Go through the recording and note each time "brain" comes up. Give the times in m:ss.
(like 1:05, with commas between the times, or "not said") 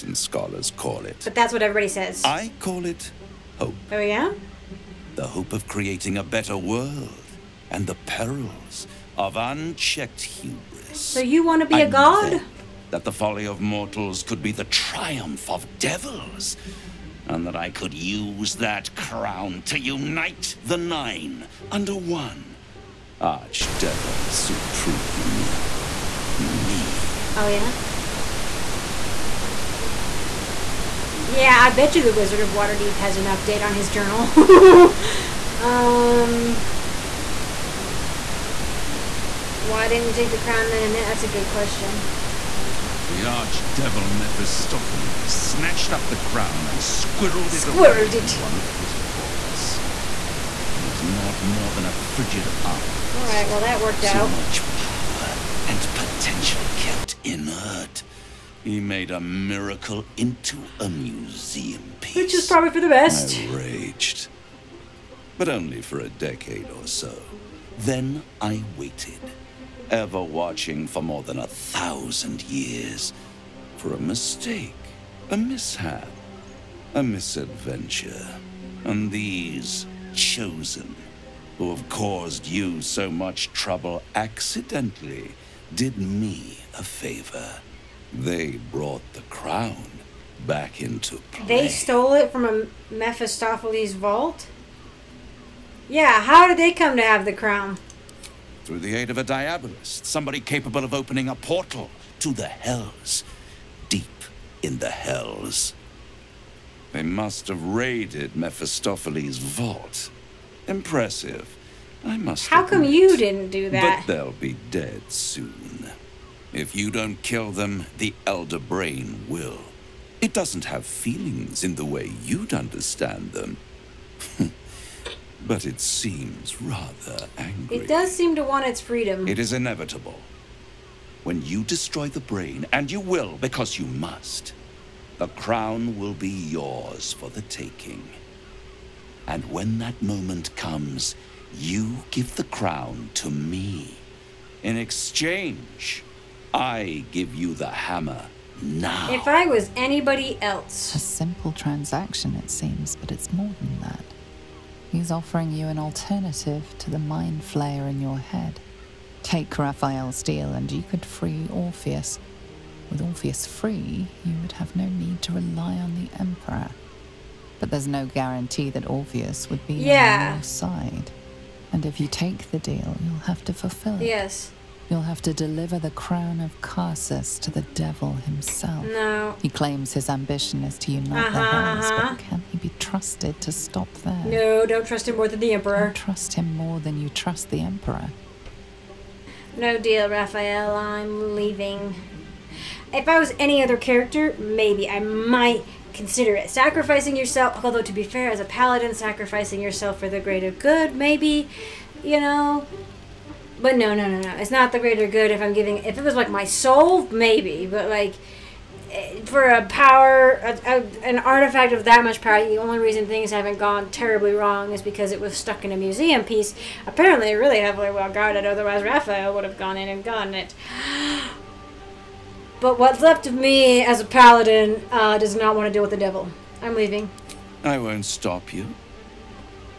1:58, 2:12.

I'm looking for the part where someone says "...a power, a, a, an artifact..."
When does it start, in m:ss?
3:29.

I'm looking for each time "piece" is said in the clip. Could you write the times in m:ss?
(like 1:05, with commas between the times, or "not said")
1:01, 3:36.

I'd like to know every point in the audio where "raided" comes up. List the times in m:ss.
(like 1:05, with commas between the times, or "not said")
1:47.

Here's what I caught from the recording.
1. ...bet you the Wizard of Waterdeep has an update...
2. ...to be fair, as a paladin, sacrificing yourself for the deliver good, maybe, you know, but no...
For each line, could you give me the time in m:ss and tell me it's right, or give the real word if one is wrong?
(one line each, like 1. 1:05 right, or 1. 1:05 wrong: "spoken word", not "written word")
1. 0:31 right
2. 3:17 wrong: "greater", not "deliver".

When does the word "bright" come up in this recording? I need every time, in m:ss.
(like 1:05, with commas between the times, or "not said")
not said.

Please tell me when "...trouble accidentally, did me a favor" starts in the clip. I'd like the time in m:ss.
1:23.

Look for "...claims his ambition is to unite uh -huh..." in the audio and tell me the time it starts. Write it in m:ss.
2:59.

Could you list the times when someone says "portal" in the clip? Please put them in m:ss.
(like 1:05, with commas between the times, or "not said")
1:41.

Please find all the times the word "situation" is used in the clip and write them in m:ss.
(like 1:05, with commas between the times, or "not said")
not said.